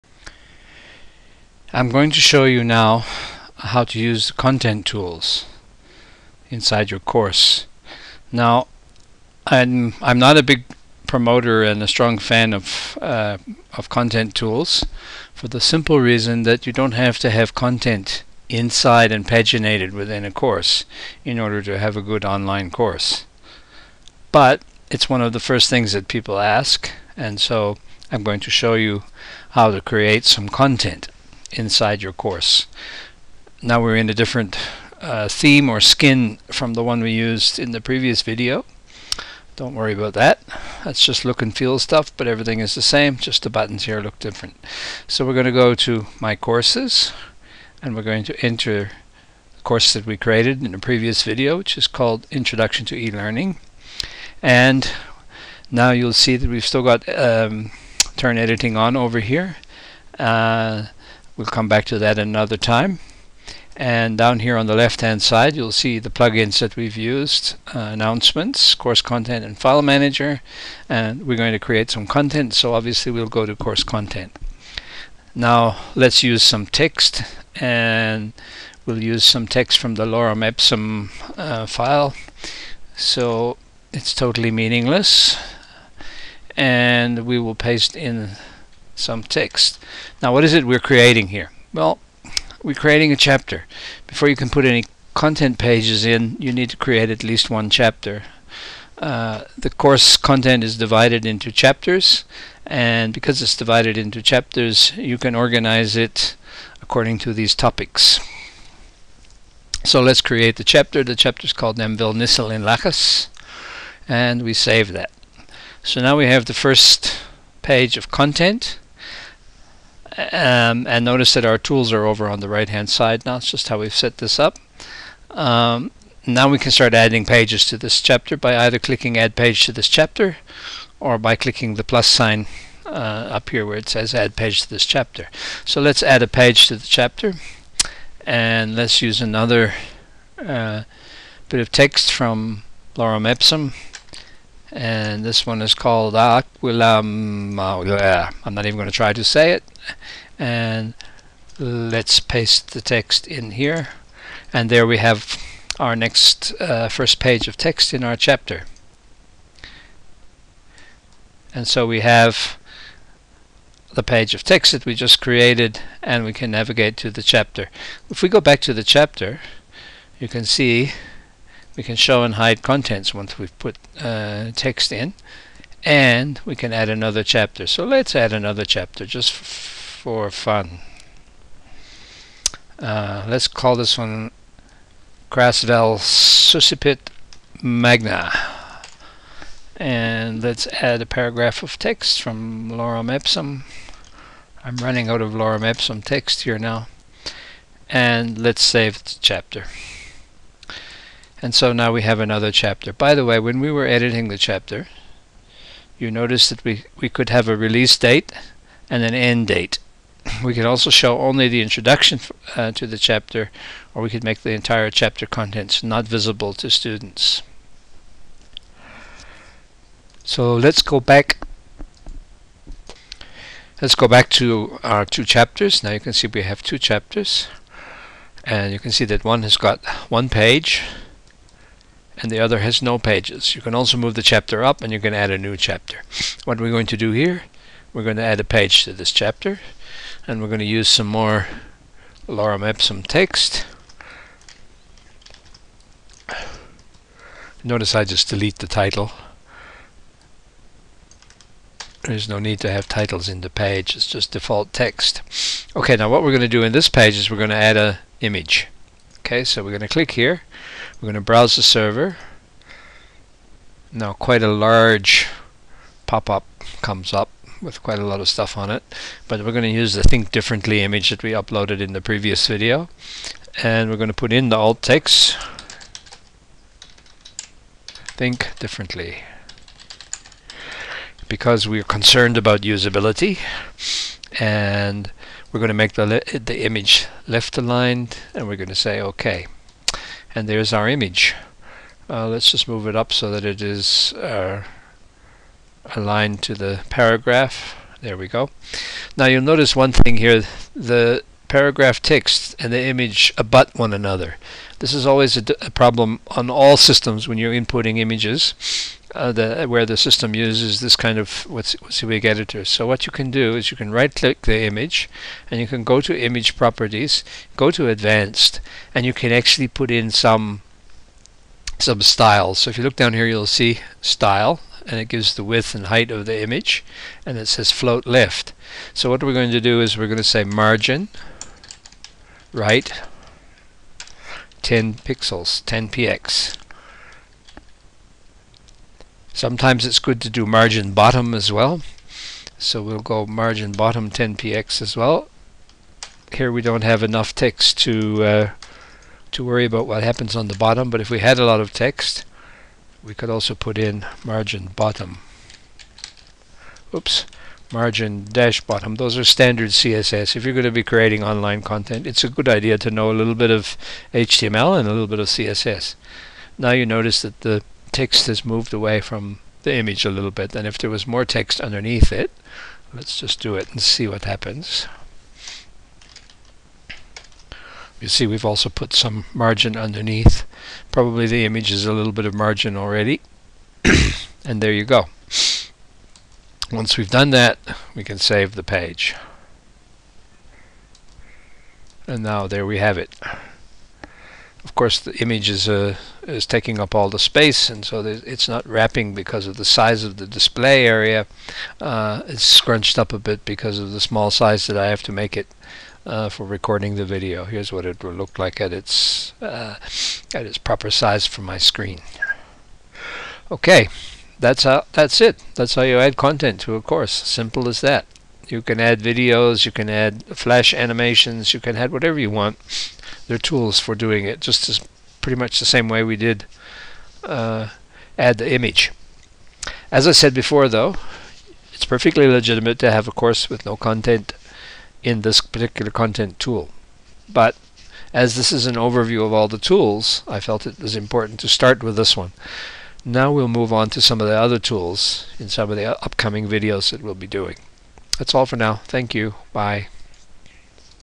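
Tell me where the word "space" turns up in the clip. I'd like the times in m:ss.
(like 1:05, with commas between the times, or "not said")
6:37.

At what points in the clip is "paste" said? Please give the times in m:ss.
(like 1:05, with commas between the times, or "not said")
1:27, 2:32.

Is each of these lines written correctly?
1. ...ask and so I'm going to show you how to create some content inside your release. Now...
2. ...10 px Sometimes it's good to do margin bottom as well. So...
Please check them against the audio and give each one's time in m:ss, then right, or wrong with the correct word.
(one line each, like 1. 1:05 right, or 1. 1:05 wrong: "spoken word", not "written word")
1. 0:26 wrong: "course", not "release"
2. 5:35 right.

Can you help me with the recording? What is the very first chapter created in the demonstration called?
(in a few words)
Nemvil Nissel in Lachas.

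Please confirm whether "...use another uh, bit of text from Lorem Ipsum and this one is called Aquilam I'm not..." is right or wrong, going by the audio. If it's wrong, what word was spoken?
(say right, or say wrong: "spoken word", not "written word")
right.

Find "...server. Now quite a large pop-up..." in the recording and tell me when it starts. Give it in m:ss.
4:21.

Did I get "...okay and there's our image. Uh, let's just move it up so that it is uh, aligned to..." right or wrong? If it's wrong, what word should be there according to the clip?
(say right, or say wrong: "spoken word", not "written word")
right.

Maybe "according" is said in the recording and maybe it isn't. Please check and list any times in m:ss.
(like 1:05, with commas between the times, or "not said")
1:46.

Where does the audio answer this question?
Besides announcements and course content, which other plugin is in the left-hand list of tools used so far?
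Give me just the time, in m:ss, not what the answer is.
1:09.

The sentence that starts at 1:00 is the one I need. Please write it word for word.
Uh, We'll come back to that another time.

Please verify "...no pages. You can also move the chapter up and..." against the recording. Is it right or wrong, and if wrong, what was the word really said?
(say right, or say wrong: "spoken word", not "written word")
right.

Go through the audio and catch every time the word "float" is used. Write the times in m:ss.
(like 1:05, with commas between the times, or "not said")
5:27.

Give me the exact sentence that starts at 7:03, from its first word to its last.
There are tools for doing it, just as pretty much the same way we did uh, add the image.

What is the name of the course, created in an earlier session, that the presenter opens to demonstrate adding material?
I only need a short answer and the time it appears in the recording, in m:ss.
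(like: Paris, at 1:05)
Introduction to E-Learning, at 0:52.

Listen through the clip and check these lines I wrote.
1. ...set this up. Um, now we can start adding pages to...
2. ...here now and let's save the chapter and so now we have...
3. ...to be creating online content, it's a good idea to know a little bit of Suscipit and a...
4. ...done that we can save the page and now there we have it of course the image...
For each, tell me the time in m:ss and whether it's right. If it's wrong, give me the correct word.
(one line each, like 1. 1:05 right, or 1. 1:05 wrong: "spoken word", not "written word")
1. 2:03 right
2. 3:16 right
3. 6:00 wrong: "HTML", not "Suscipit"
4. 6:27 right.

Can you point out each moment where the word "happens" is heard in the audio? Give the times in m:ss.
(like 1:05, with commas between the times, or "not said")
5:50, 6:14.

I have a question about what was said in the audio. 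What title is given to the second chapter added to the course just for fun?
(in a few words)
Grasvel Suscipit Magna.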